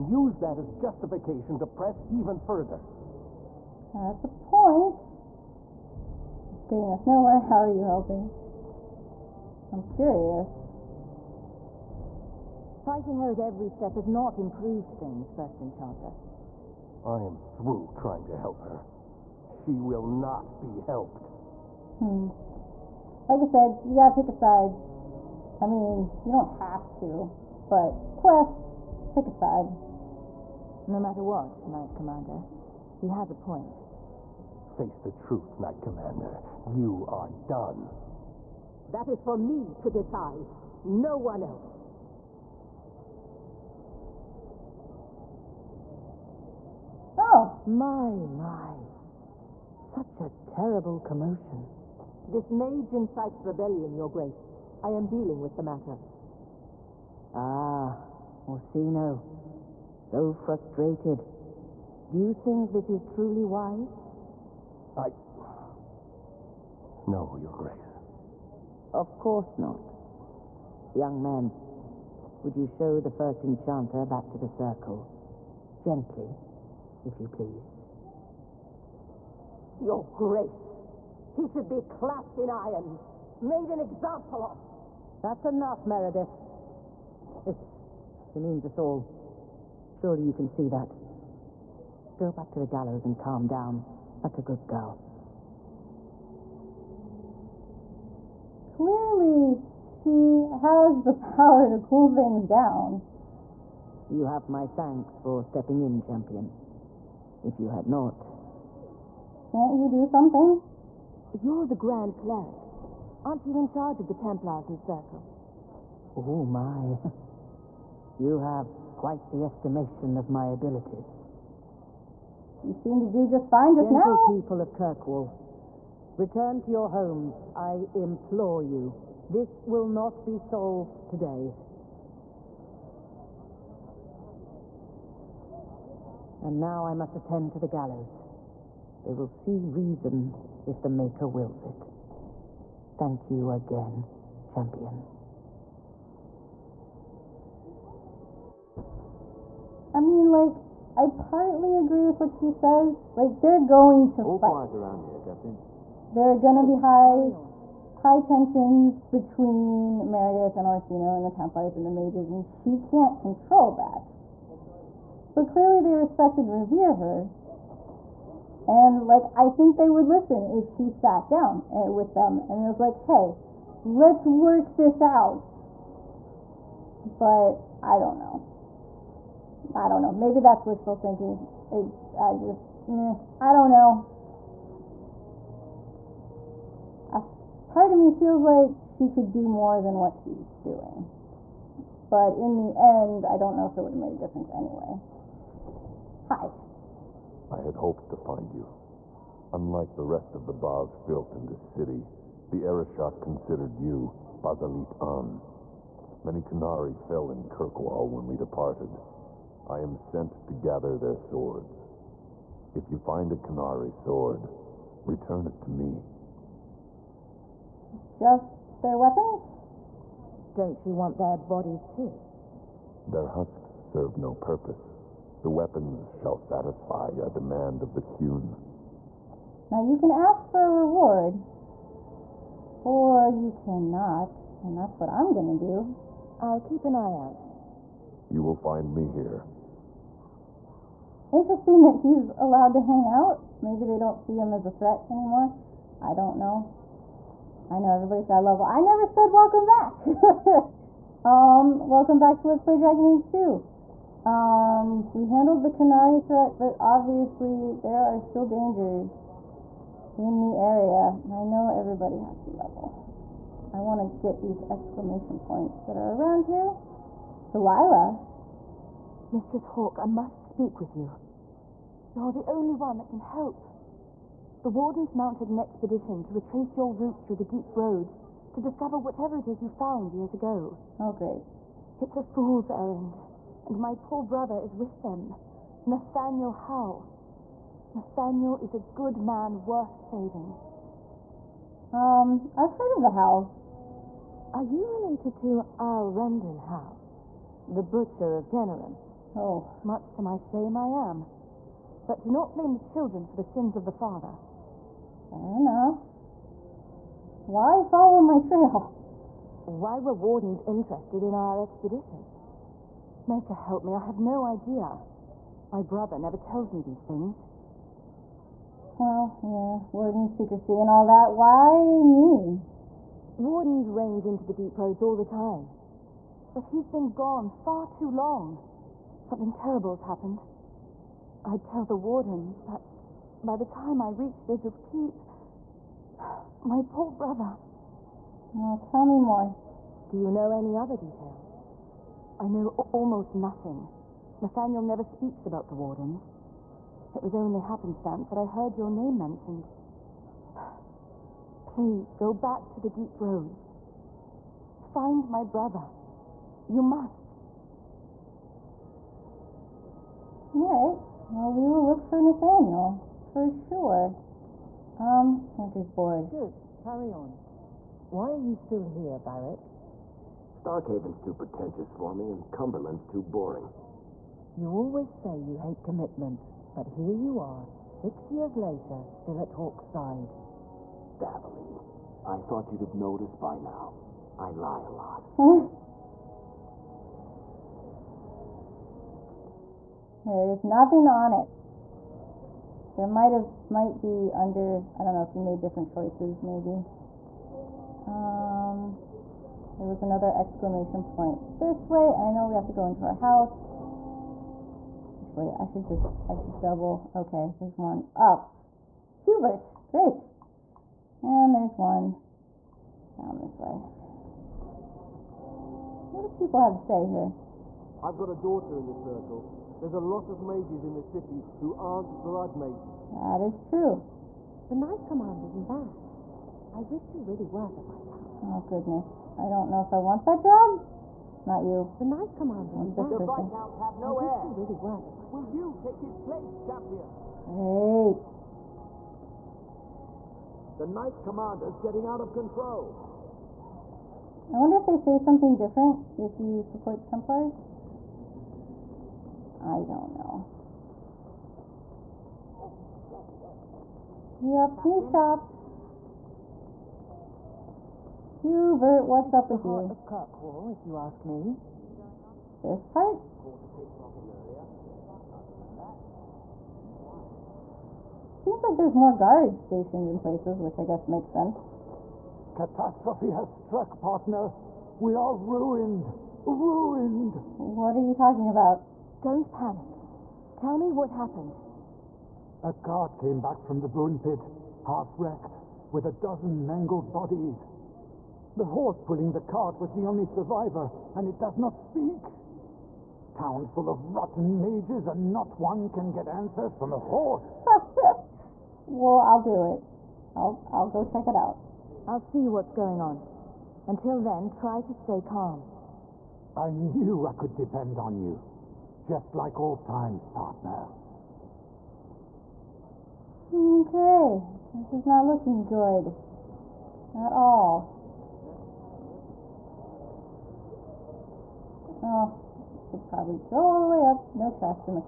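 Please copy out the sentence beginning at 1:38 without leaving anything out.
Clearly, she has the power to cool things down.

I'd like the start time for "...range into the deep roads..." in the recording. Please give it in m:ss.
5:23.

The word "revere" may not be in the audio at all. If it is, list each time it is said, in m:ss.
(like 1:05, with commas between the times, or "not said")
2:46.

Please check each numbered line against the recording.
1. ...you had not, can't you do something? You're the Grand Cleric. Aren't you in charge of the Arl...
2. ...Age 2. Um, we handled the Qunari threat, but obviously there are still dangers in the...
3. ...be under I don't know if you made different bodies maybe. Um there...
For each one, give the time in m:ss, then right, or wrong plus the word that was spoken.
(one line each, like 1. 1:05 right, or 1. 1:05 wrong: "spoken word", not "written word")
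1. 1:47 wrong: "Templars", not "Arl"
2. 4:13 right
3. 6:34 wrong: "choices", not "bodies".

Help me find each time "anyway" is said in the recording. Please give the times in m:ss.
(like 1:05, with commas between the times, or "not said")
3:14.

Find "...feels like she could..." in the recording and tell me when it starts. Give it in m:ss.
3:08.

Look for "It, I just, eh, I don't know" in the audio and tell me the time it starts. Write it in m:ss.
3:01.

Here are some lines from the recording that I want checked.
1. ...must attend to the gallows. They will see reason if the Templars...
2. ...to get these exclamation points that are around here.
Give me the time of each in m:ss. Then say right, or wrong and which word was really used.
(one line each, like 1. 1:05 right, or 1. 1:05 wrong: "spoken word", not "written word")
1. 2:16 wrong: "Maker", not "Templars"
2. 4:24 right.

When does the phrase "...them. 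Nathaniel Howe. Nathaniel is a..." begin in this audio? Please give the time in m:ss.
4:45.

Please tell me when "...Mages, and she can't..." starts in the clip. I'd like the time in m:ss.
2:41.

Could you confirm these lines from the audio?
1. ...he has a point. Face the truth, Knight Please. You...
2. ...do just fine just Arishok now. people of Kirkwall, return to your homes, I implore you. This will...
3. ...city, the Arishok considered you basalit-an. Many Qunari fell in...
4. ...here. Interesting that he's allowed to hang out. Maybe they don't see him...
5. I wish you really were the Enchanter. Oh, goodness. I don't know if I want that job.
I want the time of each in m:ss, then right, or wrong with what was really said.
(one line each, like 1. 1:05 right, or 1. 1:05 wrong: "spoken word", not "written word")
1. 0:33 wrong: "Commander", not "Please"
2. 2:03 wrong: "Gentle", not "Arishok"
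3. 3:21 right
4. 3:59 right
5. 7:06 wrong: "Viscount", not "Enchanter".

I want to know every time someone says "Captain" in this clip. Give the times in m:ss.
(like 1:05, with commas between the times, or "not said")
2:35, 7:34.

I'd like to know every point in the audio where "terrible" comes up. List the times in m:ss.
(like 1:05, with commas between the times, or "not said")
0:50, 5:29.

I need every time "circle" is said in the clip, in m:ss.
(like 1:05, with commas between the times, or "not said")
1:14, 1:54, 6:58.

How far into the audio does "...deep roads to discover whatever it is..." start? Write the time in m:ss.
4:37.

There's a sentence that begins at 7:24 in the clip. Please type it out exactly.
I wonder if they say something different if you support the Templars.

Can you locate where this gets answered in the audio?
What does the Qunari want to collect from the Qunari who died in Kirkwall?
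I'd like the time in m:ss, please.
3:31.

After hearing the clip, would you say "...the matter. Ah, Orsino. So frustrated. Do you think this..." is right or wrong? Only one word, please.
right.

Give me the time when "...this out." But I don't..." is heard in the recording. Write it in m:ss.
2:54.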